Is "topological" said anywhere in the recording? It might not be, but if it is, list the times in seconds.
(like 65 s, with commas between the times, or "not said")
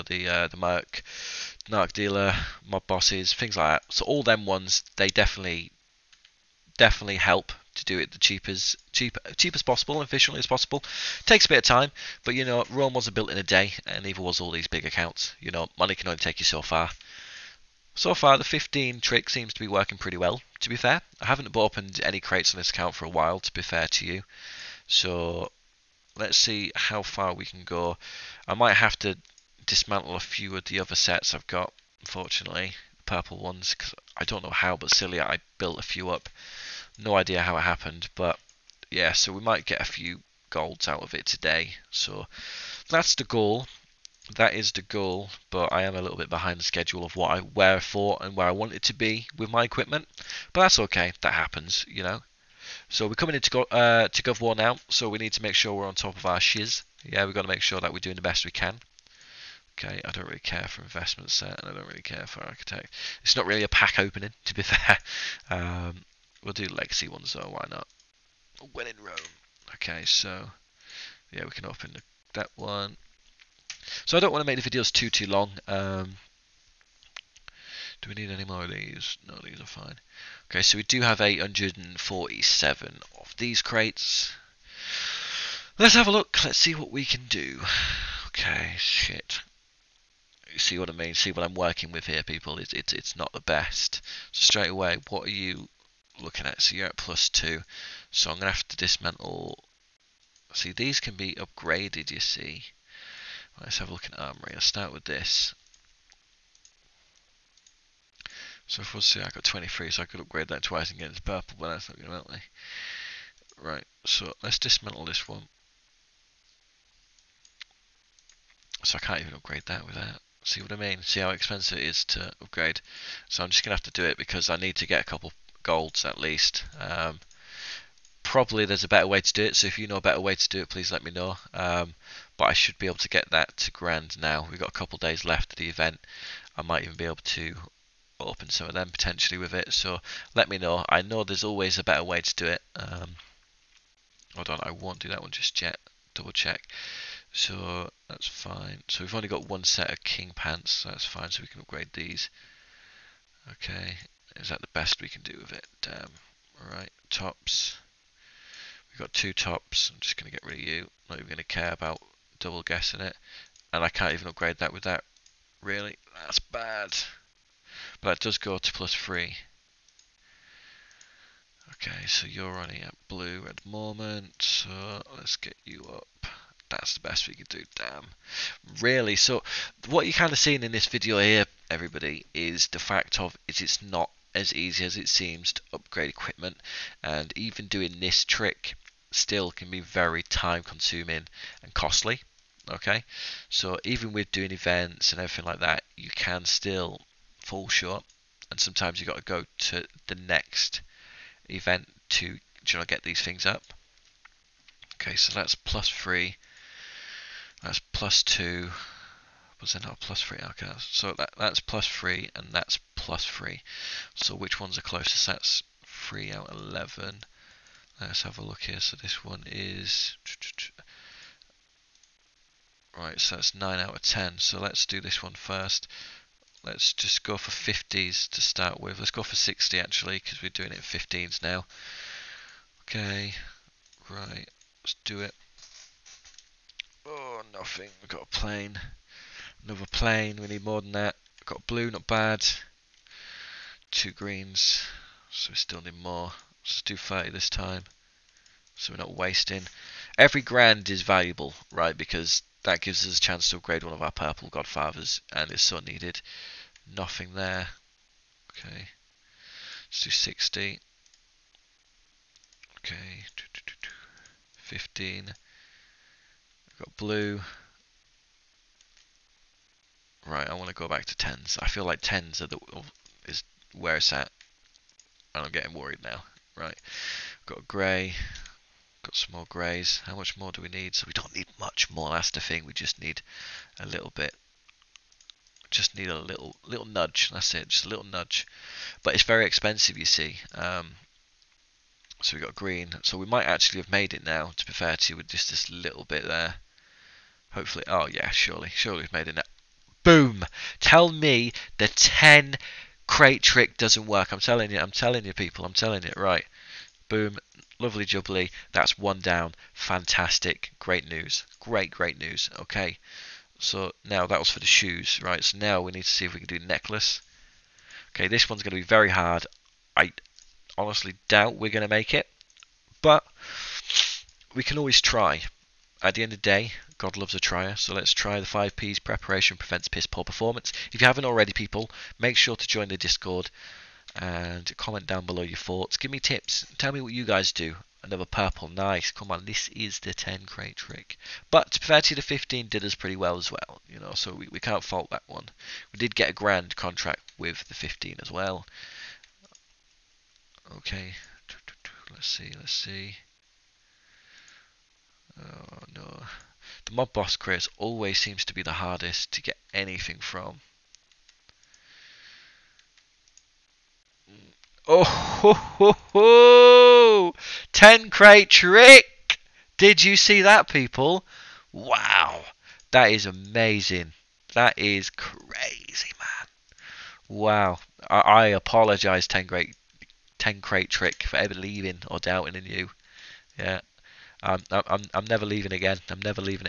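not said.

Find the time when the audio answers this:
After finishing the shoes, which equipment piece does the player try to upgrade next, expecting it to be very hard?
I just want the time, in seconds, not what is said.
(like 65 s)
316 s.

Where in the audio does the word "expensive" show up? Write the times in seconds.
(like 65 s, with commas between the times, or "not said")
121 s, 289 s.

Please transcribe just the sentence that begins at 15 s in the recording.
You know, money can only take you so far.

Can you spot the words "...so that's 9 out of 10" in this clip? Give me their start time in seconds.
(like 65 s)
223 s.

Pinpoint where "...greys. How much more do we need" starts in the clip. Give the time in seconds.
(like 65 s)
279 s.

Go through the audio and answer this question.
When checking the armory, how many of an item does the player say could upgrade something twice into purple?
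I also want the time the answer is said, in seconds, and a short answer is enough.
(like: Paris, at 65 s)
23, at 109 s.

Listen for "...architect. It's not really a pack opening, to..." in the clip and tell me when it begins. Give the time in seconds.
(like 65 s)
62 s.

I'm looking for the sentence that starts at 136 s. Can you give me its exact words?
I might even be able to open some of them potentially with it.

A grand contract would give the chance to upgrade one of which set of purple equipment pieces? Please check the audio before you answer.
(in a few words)
Godfathers.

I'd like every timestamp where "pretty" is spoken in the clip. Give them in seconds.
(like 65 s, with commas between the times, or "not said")
19 s, 342 s.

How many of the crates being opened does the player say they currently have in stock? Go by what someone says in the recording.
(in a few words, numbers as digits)
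847.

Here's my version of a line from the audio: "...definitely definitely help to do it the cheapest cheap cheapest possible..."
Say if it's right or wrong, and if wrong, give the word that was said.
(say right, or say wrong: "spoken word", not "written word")
right.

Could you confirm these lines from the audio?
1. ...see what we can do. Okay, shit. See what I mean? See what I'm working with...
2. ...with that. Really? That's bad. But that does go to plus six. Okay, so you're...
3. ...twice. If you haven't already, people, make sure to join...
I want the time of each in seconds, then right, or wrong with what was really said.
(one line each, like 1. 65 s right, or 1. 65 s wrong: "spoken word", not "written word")
1. 86 s right
2. 164 s wrong: "three", not "six"
3. 330 s wrong: "performance", not "twice".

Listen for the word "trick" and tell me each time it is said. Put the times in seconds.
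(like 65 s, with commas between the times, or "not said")
18 s, 188 s, 303 s, 340 s, 368 s, 380 s.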